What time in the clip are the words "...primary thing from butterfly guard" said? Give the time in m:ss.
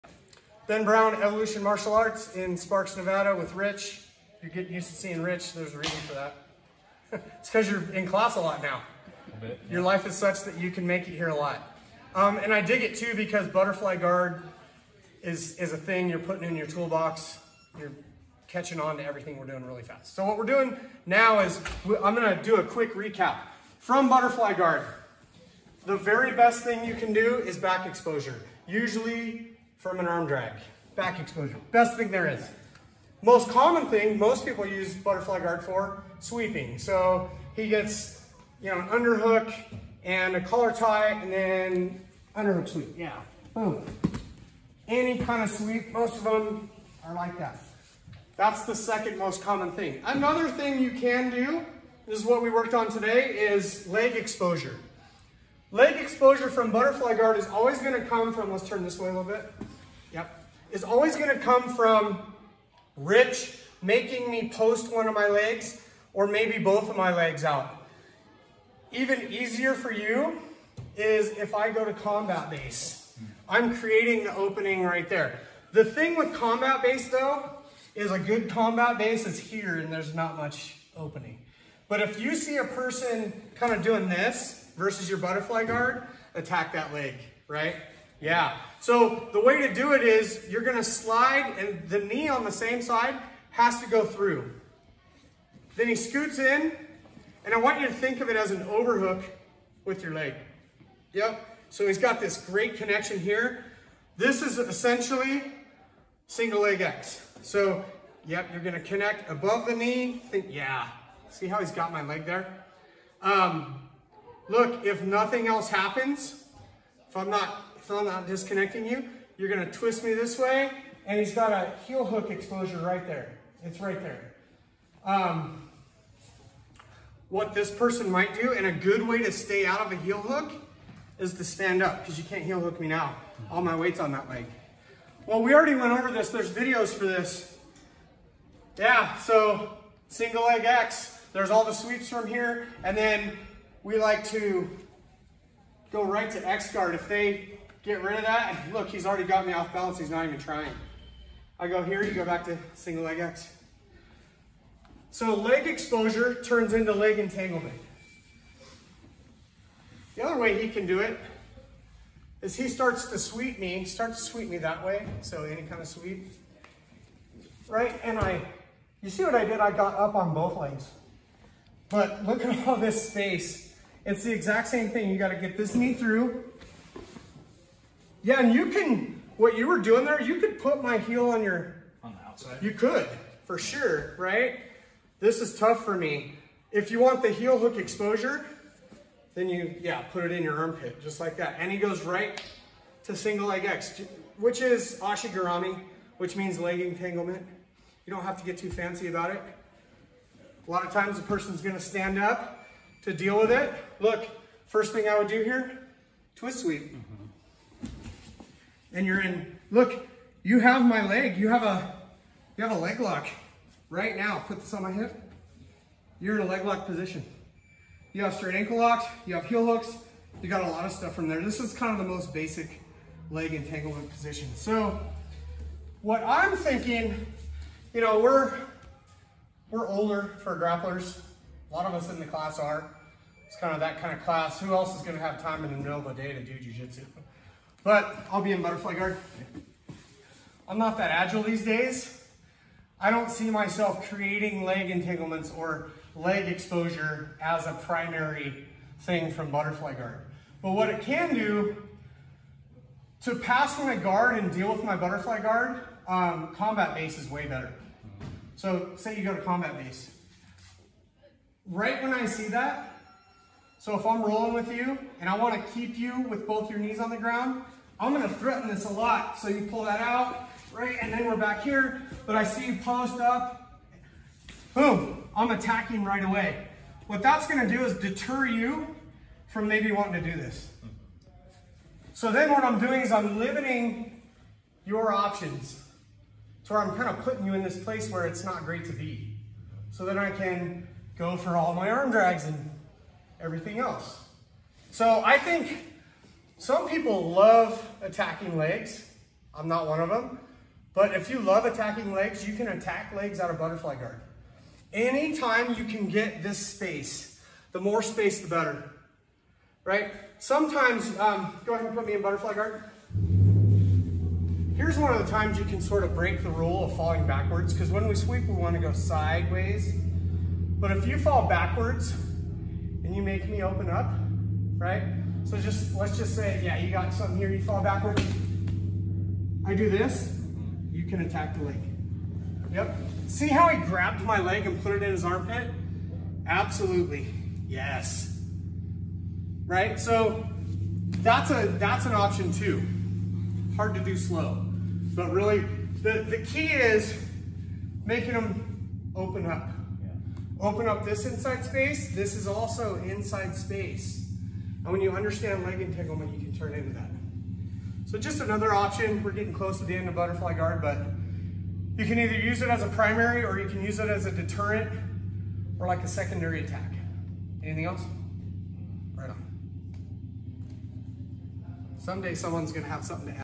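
4:07.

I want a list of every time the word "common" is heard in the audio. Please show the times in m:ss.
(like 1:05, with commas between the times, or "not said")
0:33, 0:49.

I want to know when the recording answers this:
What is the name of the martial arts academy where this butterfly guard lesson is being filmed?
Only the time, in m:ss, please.
0:01.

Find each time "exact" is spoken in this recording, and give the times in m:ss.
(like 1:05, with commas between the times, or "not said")
2:54.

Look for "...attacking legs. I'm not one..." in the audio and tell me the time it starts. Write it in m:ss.
4:58.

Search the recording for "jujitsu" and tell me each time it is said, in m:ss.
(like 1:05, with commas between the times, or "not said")
3:56.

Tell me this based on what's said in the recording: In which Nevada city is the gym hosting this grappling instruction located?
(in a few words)
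Sparks.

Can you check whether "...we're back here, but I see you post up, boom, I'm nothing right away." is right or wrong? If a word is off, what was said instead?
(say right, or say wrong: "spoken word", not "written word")
wrong: "attacking", not "nothing".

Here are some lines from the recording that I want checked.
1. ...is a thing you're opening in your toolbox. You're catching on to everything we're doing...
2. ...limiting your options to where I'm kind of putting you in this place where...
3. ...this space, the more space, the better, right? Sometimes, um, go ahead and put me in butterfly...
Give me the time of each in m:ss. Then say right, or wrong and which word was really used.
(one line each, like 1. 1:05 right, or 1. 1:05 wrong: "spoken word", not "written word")
1. 0:15 wrong: "putting", not "opening"
2. 4:43 right
3. 5:06 right.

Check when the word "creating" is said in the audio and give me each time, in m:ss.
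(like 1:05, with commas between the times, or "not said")
1:13, 4:04.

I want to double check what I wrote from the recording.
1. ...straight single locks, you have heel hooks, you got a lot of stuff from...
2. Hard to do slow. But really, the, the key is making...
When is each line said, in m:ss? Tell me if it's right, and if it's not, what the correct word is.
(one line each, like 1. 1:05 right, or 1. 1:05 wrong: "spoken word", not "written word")
1. 3:38 wrong: "ankle", not "single"
2. 5:43 right.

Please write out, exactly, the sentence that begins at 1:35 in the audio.
Then he scoots in and I want you to think of it as an overhook with your leg.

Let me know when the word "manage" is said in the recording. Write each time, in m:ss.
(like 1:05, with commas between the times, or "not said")
not said.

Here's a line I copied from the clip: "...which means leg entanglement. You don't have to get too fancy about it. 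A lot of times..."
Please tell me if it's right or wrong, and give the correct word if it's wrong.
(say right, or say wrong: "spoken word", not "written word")
right.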